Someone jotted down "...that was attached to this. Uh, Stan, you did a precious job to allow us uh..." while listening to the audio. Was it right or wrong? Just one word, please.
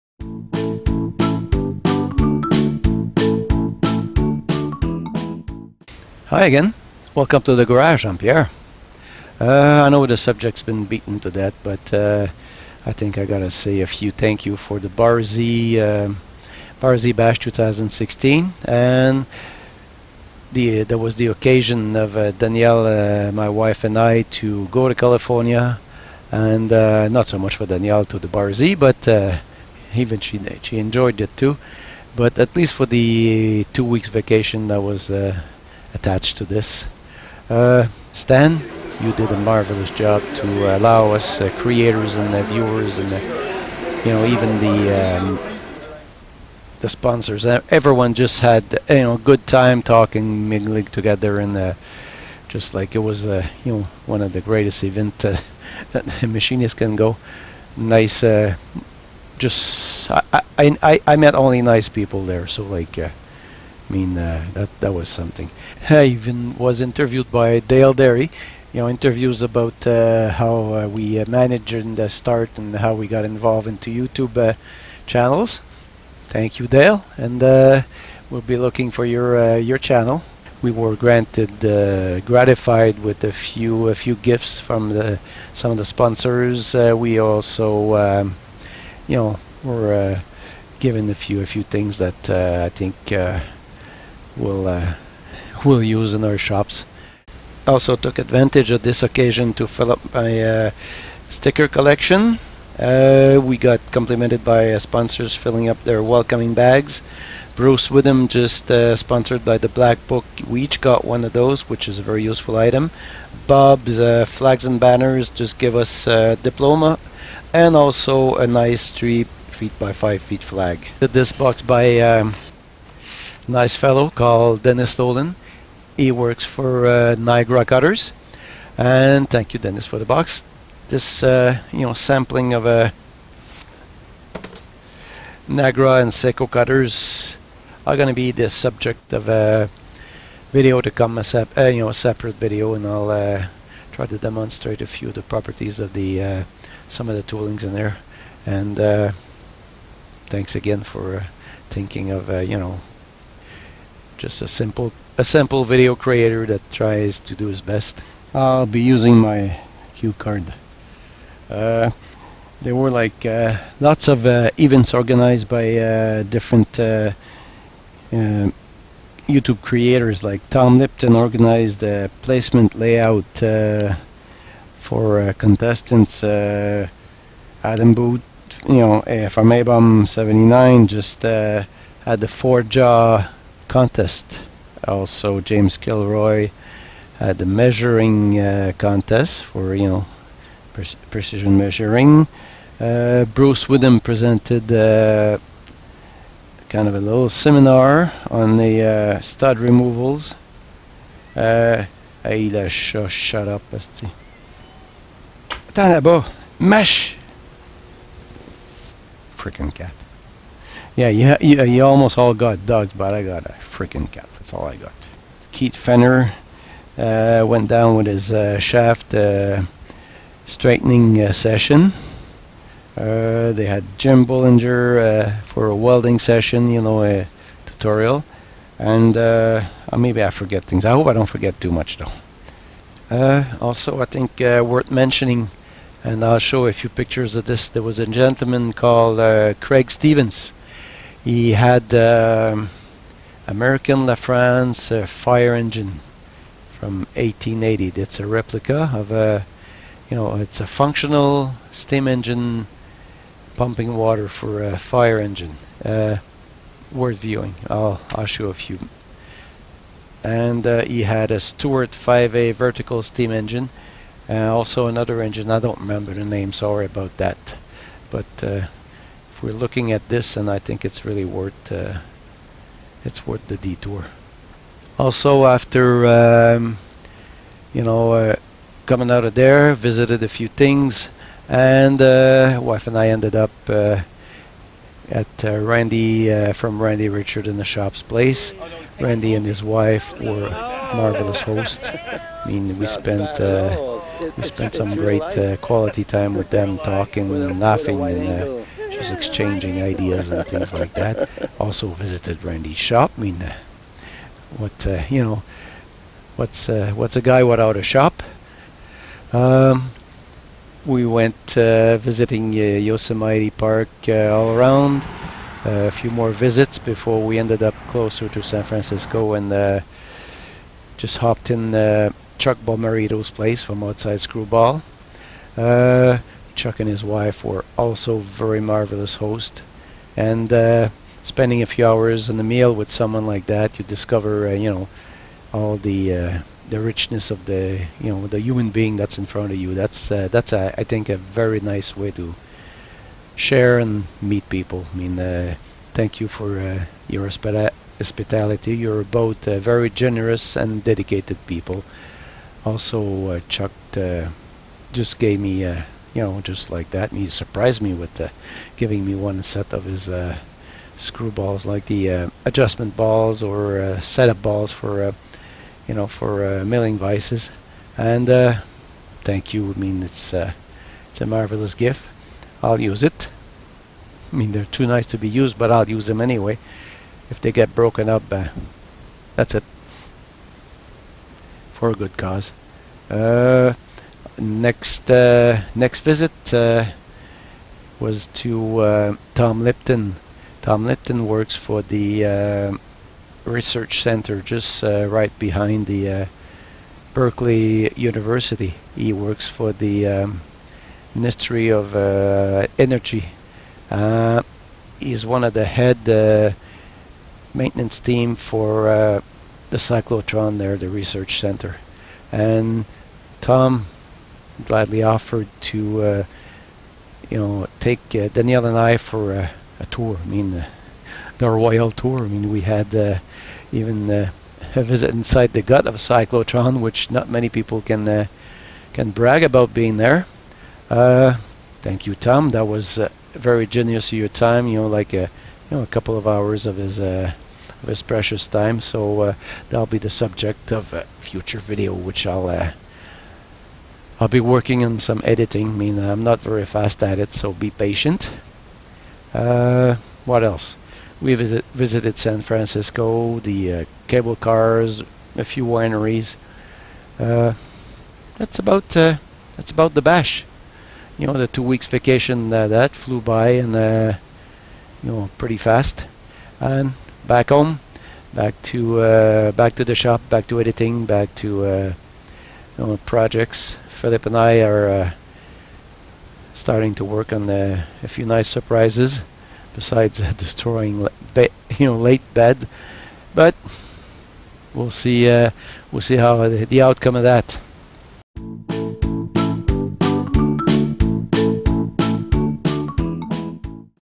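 wrong.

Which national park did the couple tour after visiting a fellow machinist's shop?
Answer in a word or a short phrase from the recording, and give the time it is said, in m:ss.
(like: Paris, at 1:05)
Yosemite, at 5:12.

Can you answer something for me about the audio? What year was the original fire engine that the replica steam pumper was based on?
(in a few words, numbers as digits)
1880.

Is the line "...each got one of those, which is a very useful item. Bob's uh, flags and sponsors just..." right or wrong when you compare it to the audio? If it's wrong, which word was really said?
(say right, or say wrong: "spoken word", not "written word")
wrong: "banners", not "sponsors".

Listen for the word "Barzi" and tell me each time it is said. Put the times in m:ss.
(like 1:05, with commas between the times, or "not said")
0:14, 0:28.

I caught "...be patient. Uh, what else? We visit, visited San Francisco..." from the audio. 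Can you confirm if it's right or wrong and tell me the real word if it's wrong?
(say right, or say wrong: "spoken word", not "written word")
right.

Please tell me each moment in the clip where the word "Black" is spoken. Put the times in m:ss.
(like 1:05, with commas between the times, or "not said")
1:49.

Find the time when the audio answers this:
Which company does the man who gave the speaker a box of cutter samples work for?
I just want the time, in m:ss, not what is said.
2:07.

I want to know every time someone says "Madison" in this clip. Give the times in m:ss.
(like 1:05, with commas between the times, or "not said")
not said.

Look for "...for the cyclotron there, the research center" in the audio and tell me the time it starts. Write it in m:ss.
6:48.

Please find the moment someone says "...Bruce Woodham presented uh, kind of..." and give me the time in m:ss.
3:13.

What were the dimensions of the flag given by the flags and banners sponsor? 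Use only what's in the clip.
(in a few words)
3 feet by 5 feet.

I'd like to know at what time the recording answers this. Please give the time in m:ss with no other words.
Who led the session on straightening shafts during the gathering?
3:35.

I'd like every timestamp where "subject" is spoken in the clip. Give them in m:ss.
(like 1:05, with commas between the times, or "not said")
0:10, 2:18, 7:20.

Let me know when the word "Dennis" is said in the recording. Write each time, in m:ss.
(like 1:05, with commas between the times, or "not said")
2:04, 2:09.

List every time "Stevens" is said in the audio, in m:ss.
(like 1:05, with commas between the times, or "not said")
3:59.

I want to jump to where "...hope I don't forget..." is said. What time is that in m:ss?
3:50.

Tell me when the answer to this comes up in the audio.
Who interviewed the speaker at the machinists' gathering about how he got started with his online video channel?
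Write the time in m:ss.
1:07.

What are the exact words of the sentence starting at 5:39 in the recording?
That's uh, that's uh, I think a very nice way to share and meet people.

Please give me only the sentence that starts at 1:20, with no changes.
We were granted, gratified with a few, a few gifts from the, some of the sponsors.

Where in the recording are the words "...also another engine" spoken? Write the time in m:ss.
4:24.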